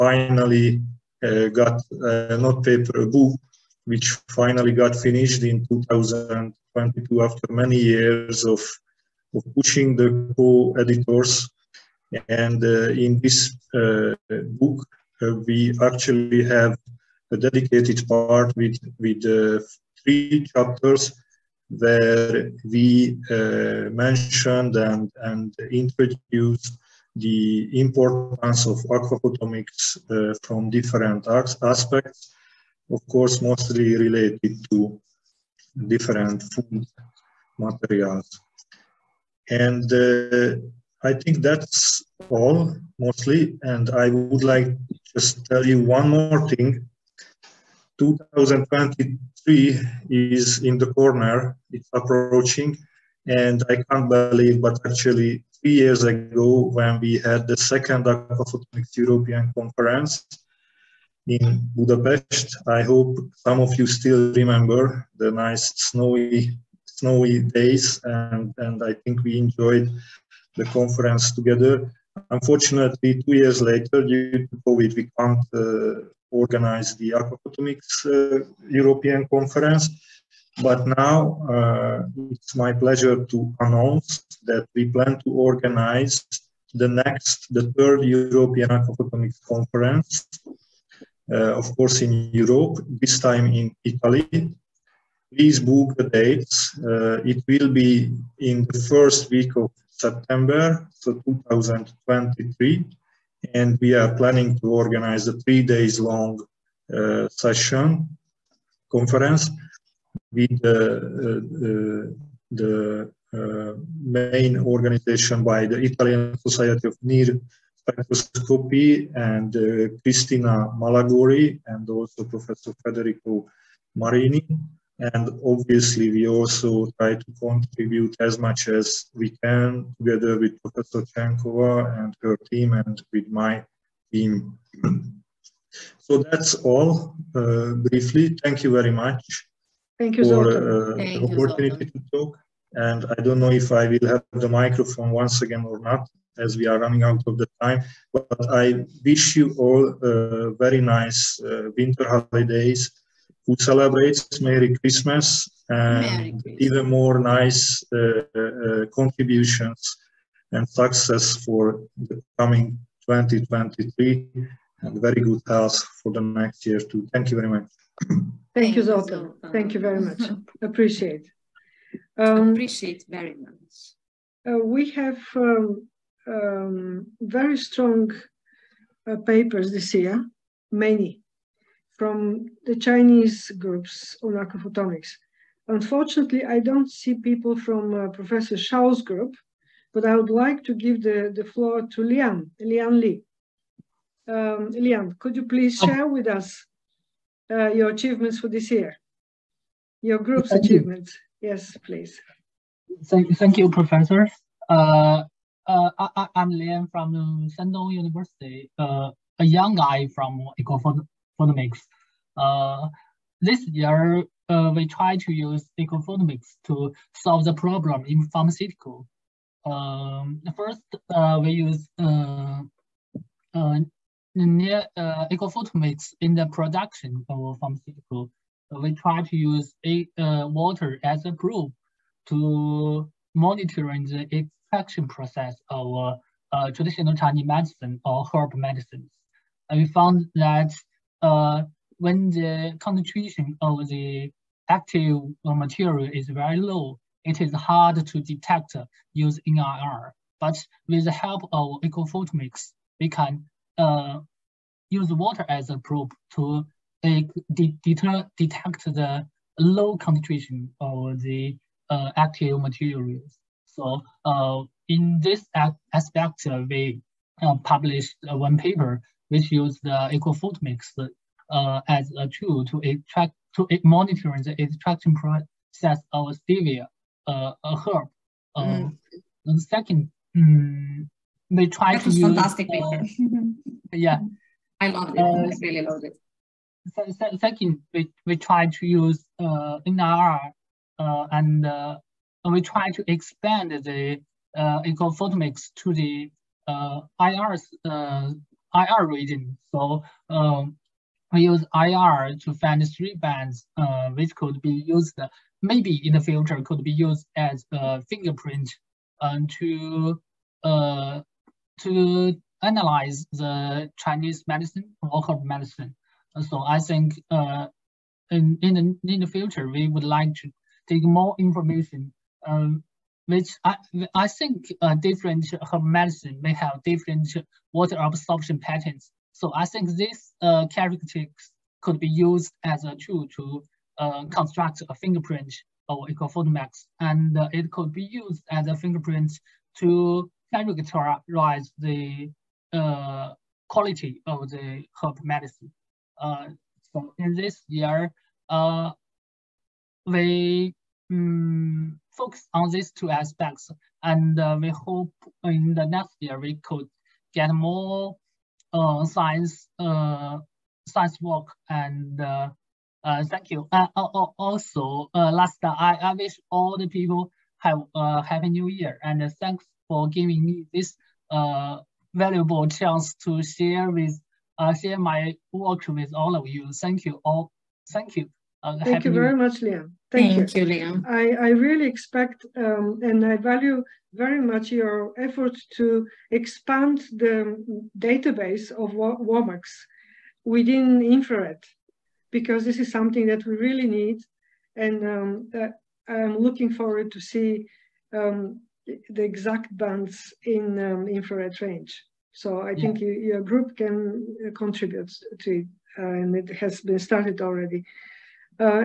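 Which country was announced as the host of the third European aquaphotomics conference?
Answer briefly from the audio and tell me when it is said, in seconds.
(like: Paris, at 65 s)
Italy, at 93 s.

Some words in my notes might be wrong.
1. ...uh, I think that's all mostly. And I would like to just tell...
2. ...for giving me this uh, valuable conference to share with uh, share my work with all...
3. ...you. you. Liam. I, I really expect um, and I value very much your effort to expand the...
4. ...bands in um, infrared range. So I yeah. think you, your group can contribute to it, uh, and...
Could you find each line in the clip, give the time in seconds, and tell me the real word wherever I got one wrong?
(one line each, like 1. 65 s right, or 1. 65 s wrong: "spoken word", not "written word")
1. 39 s right
2. 369 s wrong: "chance", not "conference"
3. 380 s right
4. 399 s right.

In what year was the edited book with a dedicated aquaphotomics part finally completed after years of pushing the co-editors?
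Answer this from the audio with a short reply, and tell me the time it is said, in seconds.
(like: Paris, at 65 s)
2022, at 5 s.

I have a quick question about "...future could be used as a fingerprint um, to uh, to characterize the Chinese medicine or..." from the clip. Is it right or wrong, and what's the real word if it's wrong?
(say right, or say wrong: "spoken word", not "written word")
wrong: "analyze", not "characterize".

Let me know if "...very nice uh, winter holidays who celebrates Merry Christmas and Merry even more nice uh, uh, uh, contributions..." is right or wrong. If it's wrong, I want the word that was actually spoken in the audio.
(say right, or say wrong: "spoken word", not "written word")
right.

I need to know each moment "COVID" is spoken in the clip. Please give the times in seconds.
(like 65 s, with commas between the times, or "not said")
74 s.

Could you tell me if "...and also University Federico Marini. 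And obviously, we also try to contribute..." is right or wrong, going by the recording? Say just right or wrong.
wrong.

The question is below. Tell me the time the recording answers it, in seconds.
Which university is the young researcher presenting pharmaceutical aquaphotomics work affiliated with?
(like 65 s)
207 s.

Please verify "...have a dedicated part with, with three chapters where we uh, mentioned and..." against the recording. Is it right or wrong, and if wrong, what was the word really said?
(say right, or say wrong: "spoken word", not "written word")
right.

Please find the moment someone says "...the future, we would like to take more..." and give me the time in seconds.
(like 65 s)
319 s.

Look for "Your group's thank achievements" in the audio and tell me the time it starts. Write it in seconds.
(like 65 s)
200 s.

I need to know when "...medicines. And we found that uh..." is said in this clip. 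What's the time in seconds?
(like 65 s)
238 s.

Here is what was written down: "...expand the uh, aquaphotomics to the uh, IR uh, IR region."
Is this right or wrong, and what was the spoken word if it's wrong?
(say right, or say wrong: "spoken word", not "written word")
right.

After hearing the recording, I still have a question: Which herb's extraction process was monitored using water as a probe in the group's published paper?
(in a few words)
Stevia.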